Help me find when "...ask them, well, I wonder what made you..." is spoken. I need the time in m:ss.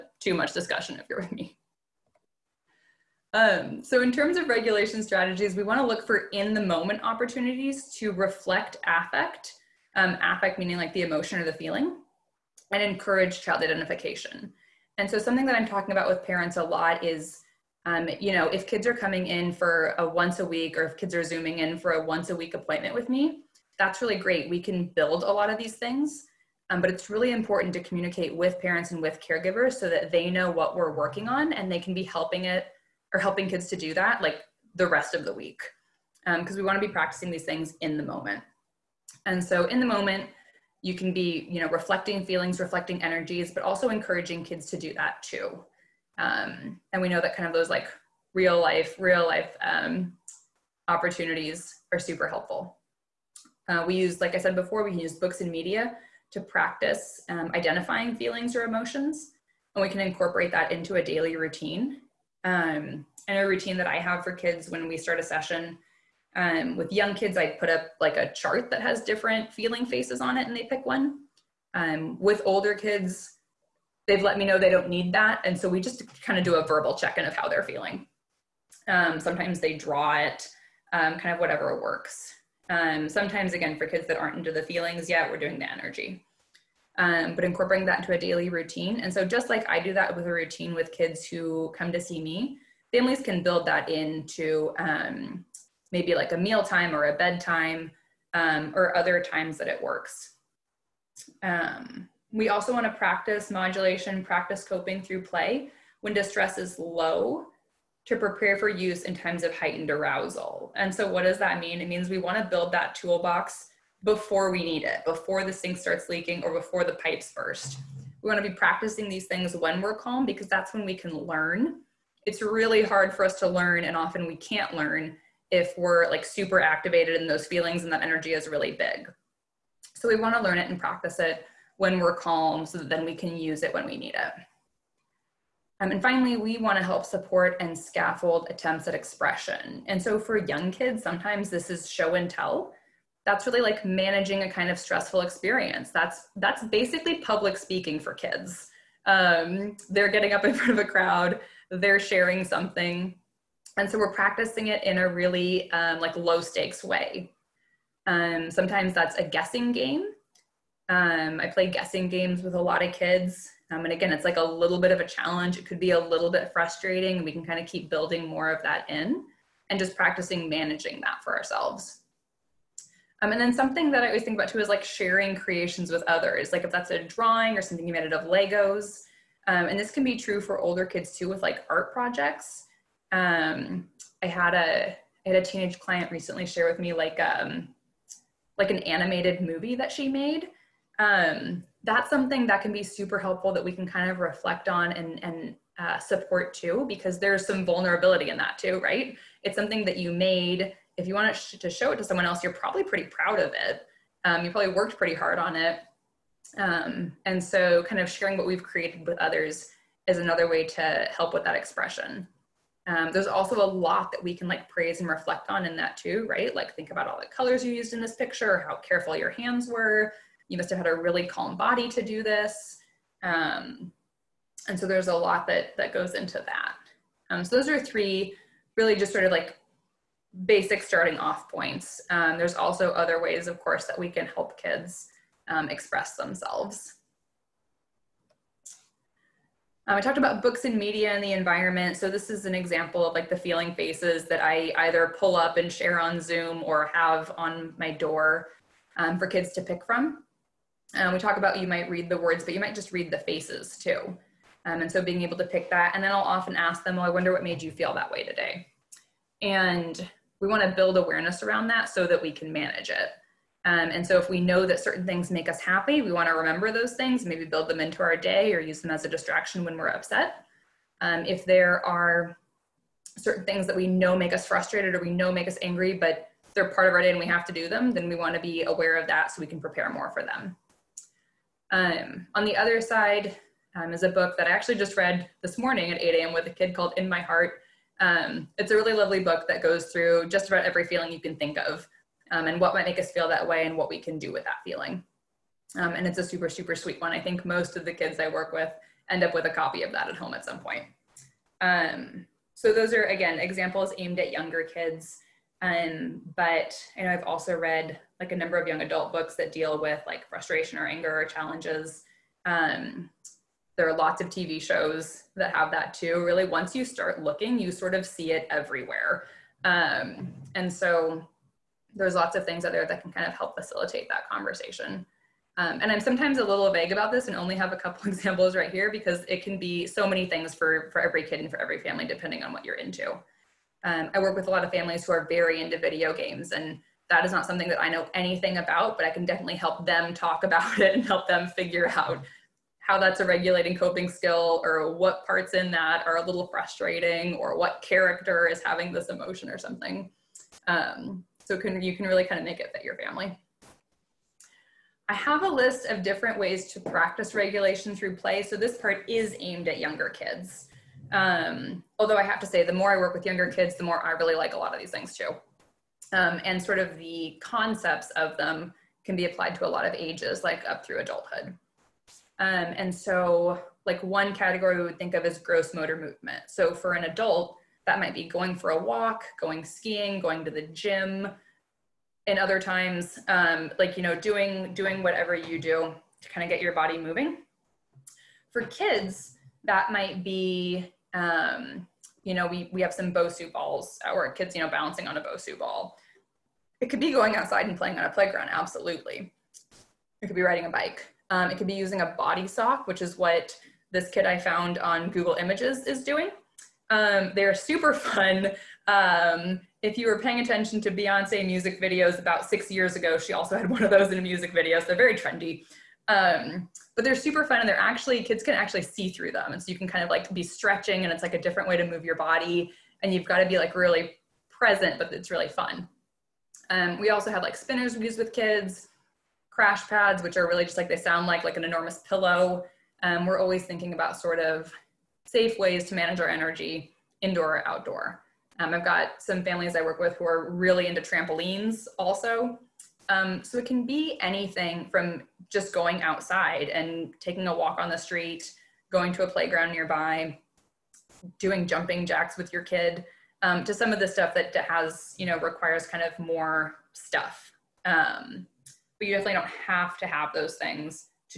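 4:16.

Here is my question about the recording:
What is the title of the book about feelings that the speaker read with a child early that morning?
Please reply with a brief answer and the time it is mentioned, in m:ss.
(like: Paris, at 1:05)
In My Heart, at 4:46.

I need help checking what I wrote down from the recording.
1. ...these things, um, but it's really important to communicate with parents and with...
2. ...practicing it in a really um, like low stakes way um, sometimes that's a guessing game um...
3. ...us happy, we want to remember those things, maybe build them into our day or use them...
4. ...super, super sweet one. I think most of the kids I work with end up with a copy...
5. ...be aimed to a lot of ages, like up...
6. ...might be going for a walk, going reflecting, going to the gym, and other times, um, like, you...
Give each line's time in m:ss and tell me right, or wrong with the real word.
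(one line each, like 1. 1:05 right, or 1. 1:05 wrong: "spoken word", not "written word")
1. 0:25 right
2. 2:34 right
3. 4:25 right
4. 4:56 right
5. 6:09 wrong: "applied", not "aimed"
6. 6:17 wrong: "skiing", not "reflecting".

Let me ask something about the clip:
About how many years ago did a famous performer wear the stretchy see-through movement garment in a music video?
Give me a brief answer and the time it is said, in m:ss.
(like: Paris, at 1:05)
6 years, at 6:52.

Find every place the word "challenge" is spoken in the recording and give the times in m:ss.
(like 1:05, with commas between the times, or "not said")
2:45, 5:11.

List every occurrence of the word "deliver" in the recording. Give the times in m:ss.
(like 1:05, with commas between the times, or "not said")
not said.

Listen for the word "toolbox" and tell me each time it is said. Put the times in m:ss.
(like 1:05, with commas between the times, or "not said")
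1:52.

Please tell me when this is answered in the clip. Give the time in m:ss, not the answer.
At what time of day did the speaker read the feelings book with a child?
4:45.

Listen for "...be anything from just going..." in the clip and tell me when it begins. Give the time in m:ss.
7:23.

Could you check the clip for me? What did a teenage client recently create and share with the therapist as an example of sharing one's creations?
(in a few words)
An animated movie.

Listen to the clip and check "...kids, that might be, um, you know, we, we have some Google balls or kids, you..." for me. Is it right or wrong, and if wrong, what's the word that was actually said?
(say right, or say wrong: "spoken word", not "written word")
wrong: "Bosu", not "Google".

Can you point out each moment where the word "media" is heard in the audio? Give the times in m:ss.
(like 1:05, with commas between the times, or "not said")
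0:55, 4:00.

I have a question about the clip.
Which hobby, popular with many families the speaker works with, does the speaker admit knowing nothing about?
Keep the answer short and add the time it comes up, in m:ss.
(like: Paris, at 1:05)
Video games, at 5:35.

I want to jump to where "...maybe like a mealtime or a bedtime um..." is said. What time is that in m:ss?
1:35.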